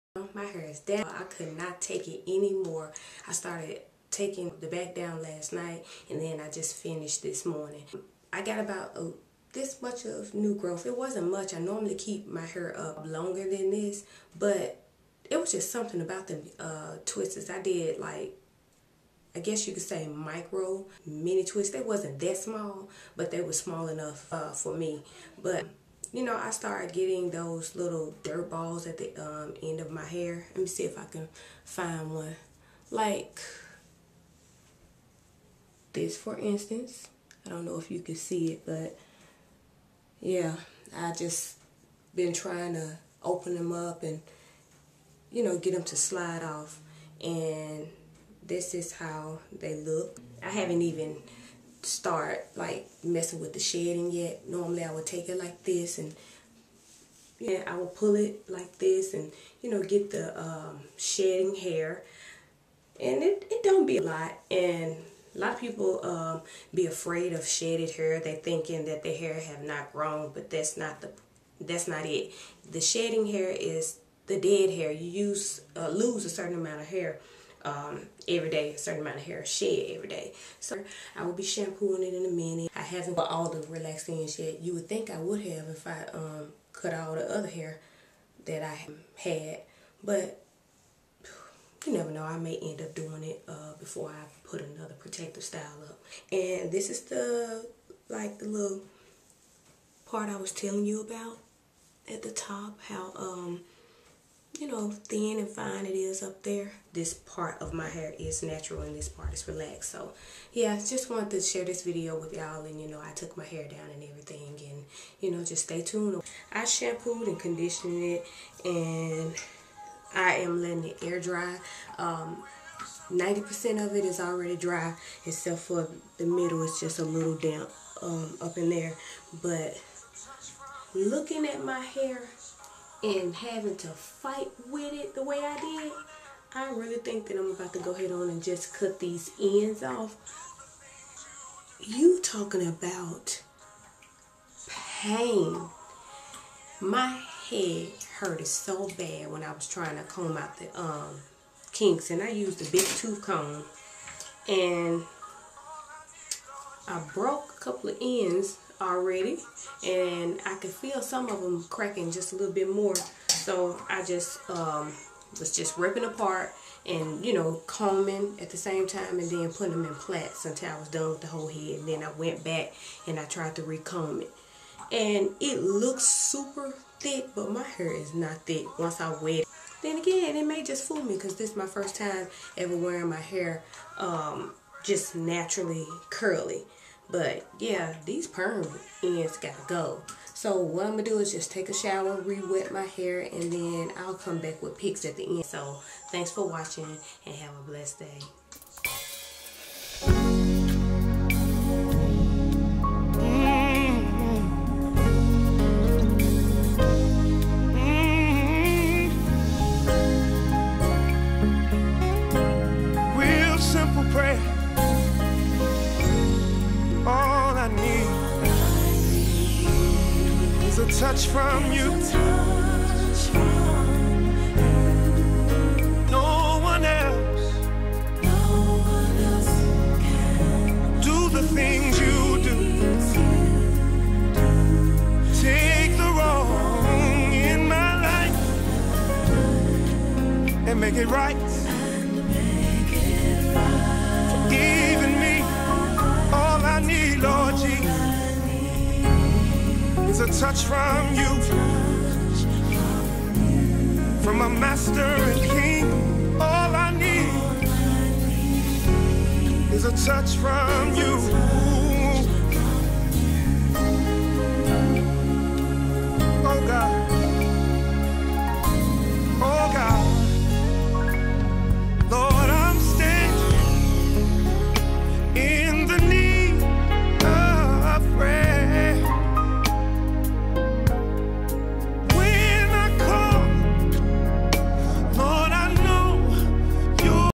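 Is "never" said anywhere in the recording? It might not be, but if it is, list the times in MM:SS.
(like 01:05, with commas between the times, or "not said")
01:31.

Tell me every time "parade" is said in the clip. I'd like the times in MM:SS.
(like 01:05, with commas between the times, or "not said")
not said.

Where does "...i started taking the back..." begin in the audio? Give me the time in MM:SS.
00:03.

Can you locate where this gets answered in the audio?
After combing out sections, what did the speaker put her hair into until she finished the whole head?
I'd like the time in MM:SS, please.
02:49.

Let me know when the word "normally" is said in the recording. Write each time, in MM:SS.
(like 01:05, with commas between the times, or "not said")
00:11, 00:54.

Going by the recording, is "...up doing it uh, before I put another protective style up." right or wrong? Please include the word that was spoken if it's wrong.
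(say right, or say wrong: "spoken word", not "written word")
right.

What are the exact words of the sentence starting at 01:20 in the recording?
So I will be shampooing it in a minute.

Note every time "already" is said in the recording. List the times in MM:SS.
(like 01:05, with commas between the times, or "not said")
02:04, 02:38.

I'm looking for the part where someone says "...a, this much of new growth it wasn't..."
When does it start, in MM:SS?
00:08.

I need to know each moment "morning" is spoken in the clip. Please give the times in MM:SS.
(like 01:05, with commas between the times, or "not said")
00:07.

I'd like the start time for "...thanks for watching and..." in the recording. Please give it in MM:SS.
03:16.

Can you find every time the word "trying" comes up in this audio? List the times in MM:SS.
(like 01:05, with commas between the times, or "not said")
00:42, 02:29.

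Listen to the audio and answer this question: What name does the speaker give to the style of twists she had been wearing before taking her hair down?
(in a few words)
micro mini twists.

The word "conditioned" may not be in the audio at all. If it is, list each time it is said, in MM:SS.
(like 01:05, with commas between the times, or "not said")
01:57.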